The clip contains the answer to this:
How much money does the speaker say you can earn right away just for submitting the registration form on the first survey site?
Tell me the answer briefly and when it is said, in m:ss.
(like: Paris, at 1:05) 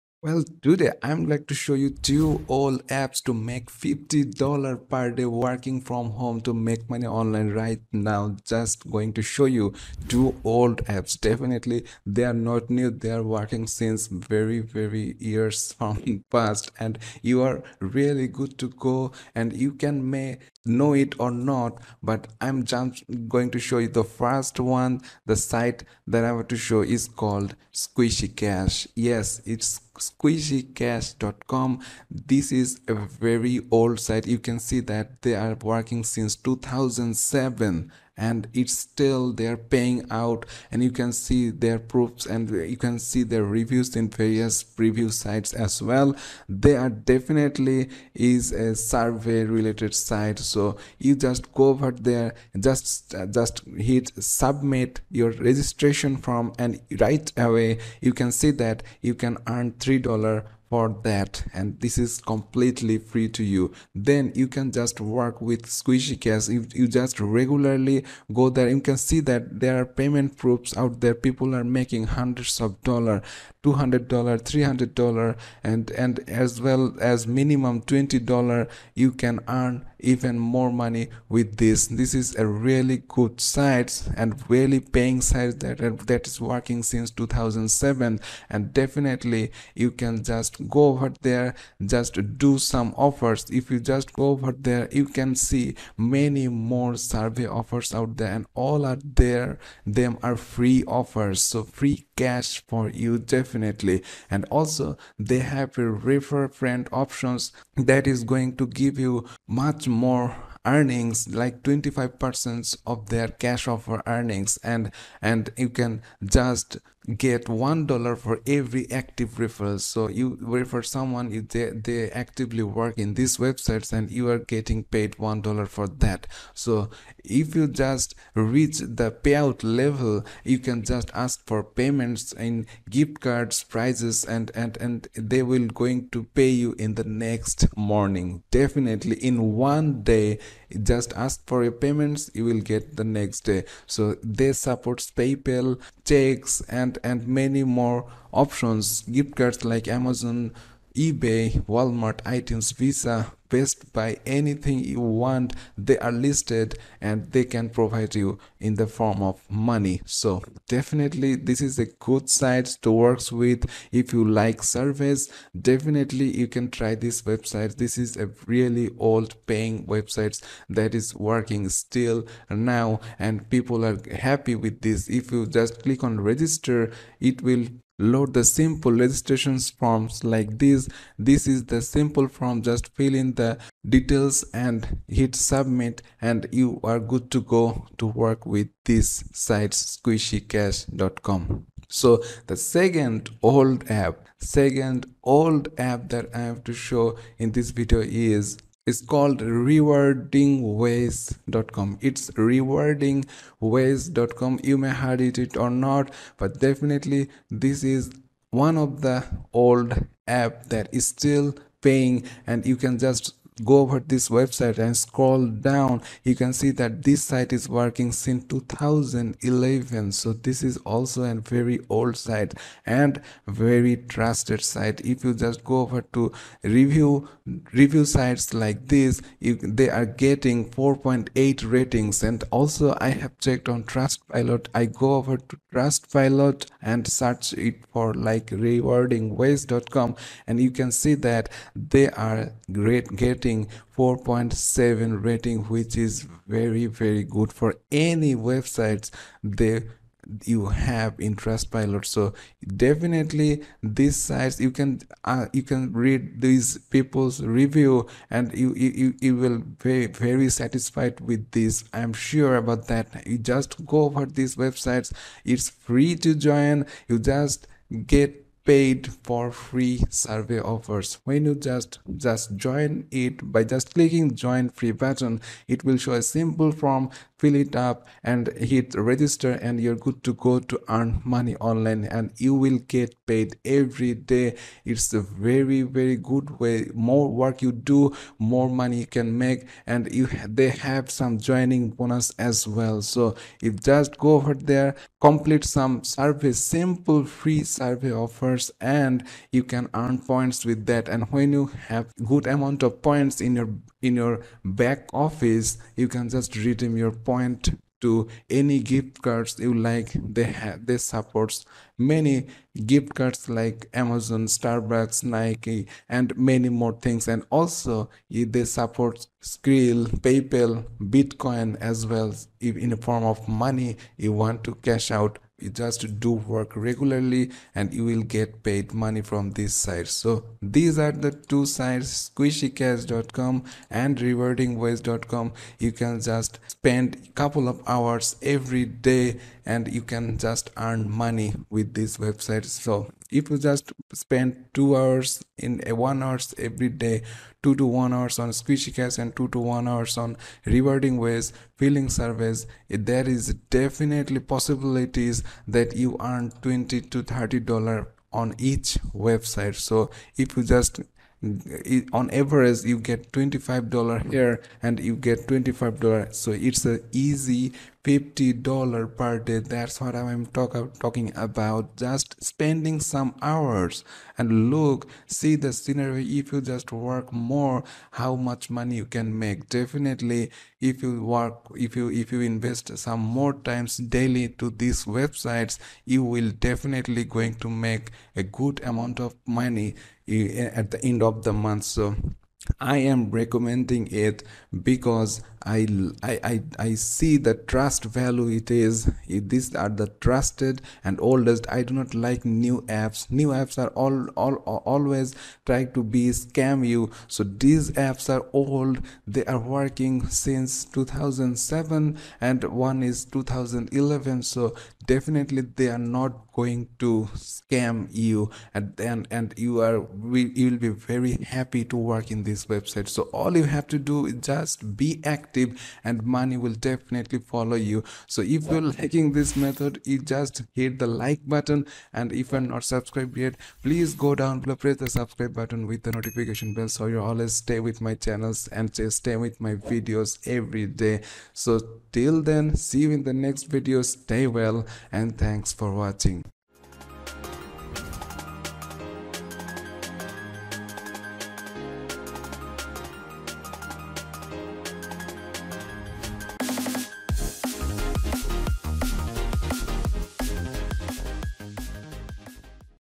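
$3, at 0:59.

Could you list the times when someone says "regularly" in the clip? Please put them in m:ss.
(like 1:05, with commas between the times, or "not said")
1:07, 5:26.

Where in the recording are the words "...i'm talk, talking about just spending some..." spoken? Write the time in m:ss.
6:10.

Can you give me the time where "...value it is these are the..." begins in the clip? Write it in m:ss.
6:38.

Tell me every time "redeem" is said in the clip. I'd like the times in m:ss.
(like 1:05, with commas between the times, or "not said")
5:06.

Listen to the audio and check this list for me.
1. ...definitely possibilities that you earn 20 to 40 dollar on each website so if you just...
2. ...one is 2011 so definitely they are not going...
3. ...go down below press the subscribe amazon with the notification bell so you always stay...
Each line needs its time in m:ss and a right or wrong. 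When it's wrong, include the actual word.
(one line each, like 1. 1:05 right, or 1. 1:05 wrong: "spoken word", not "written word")
1. 5:53 wrong: "30", not "40"
2. 6:52 right
3. 7:14 wrong: "button", not "amazon".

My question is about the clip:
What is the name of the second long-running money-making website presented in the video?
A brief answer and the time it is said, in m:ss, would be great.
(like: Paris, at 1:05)
Rewarding Ways, at 3:19.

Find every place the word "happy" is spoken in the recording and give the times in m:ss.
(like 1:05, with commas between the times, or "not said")
2:54, 7:01.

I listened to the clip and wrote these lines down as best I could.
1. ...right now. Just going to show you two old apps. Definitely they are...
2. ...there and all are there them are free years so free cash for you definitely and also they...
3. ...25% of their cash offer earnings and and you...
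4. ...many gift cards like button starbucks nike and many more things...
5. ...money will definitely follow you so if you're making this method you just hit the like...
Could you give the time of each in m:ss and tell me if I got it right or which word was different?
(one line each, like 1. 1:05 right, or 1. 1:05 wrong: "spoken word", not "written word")
1. 0:07 right
2. 1:38 wrong: "offers", not "years"
3. 1:51 right
4. 5:11 wrong: "amazon", not "button"
5. 7:06 wrong: "liking", not "making".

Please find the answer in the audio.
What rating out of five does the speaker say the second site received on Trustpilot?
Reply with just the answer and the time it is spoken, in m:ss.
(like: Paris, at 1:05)
4.7, at 4:03.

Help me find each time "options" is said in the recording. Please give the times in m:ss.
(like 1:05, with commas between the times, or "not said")
1:46, 2:28.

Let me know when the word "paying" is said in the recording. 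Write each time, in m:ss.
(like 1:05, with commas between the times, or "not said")
0:39, 1:24, 2:49, 3:31.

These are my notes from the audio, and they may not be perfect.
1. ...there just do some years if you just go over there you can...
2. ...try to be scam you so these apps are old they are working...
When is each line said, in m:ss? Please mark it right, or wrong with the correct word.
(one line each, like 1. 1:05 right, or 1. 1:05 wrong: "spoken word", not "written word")
1. 1:31 wrong: "offers", not "years"
2. 6:45 right.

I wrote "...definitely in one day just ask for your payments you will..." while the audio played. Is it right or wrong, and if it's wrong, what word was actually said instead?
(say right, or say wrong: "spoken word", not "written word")
right.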